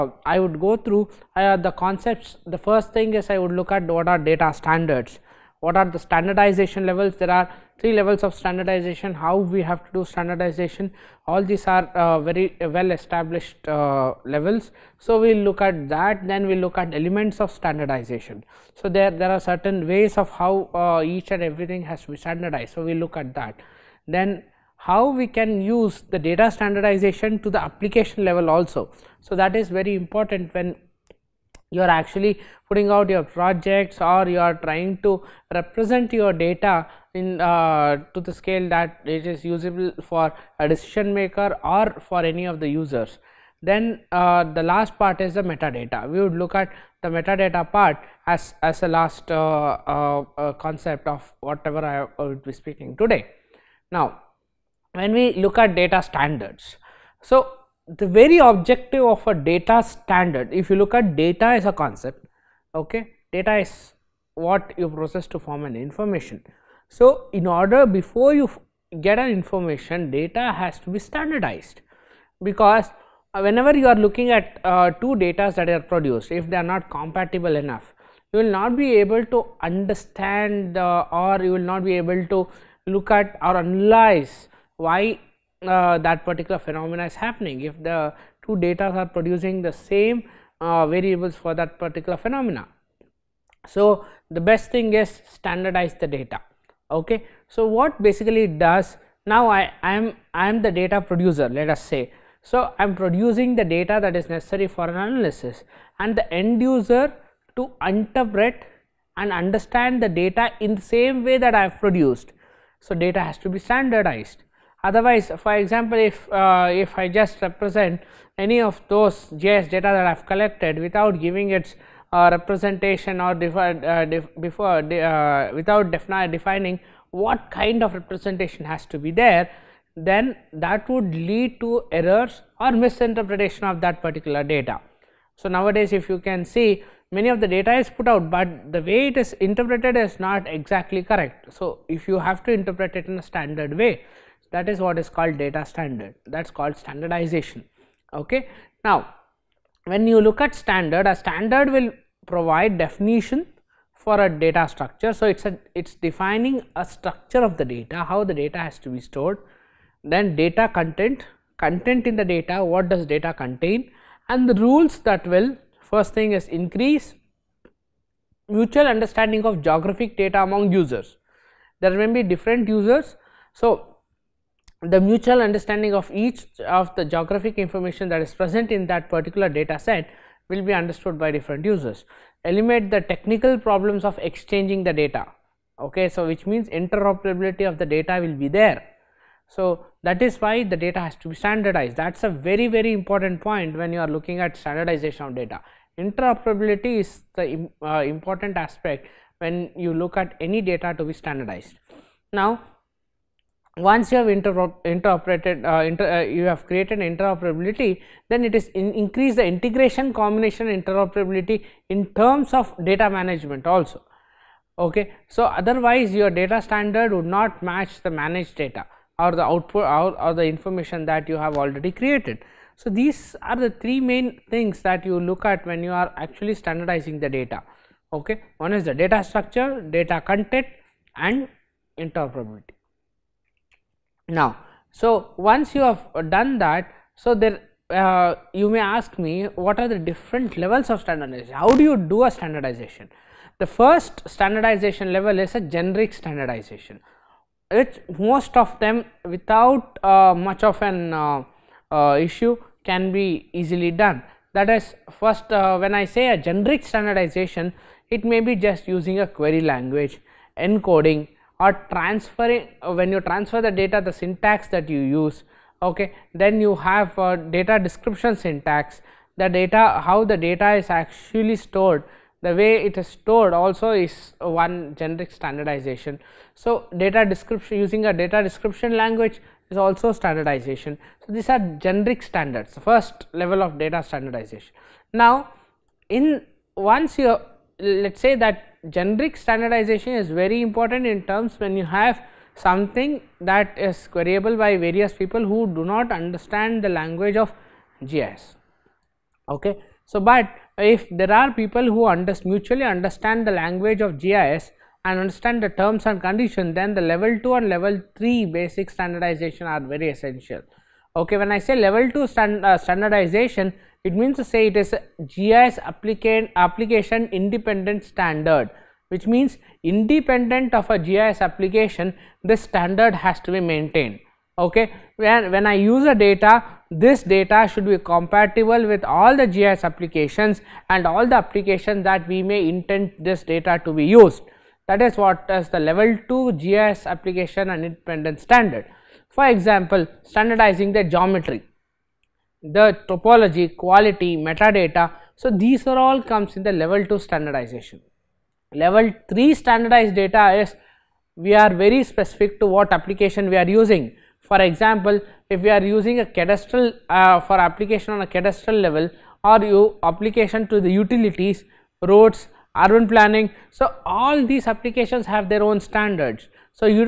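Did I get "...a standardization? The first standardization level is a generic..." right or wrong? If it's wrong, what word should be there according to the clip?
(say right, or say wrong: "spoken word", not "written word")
right.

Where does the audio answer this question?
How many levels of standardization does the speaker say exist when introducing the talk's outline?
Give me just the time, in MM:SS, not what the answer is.
00:07.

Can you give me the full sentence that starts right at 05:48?
Level 3 standardized data is we are very specific to what application we are using.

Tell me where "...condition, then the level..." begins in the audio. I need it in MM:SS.
05:06.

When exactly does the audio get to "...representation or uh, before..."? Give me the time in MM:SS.
02:02.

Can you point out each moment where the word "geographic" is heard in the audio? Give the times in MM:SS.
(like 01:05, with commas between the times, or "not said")
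02:49, 02:57.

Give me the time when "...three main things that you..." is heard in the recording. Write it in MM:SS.
03:43.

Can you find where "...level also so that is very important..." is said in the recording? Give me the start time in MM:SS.
00:28.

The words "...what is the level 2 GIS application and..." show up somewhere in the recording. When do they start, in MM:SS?
05:35.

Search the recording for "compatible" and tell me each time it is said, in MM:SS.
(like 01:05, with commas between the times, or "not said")
01:16, 05:27.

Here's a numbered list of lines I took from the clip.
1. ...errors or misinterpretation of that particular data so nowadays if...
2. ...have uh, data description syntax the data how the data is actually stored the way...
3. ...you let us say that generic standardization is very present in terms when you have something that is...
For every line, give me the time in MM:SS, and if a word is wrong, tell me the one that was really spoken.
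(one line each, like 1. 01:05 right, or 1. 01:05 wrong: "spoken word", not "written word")
1. 02:11 right
2. 04:26 right
3. 04:47 wrong: "important", not "present".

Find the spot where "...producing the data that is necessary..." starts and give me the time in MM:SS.
01:42.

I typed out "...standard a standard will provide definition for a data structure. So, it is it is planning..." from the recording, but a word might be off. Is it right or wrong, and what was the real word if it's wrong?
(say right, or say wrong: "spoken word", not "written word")
wrong: "defining", not "planning".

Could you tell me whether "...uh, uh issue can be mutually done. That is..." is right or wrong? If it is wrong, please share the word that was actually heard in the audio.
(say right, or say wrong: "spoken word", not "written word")
wrong: "easily", not "mutually".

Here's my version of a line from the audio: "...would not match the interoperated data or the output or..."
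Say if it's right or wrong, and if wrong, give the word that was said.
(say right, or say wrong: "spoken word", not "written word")
wrong: "managed", not "interoperated".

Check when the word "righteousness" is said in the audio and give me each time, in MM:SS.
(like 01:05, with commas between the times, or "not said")
not said.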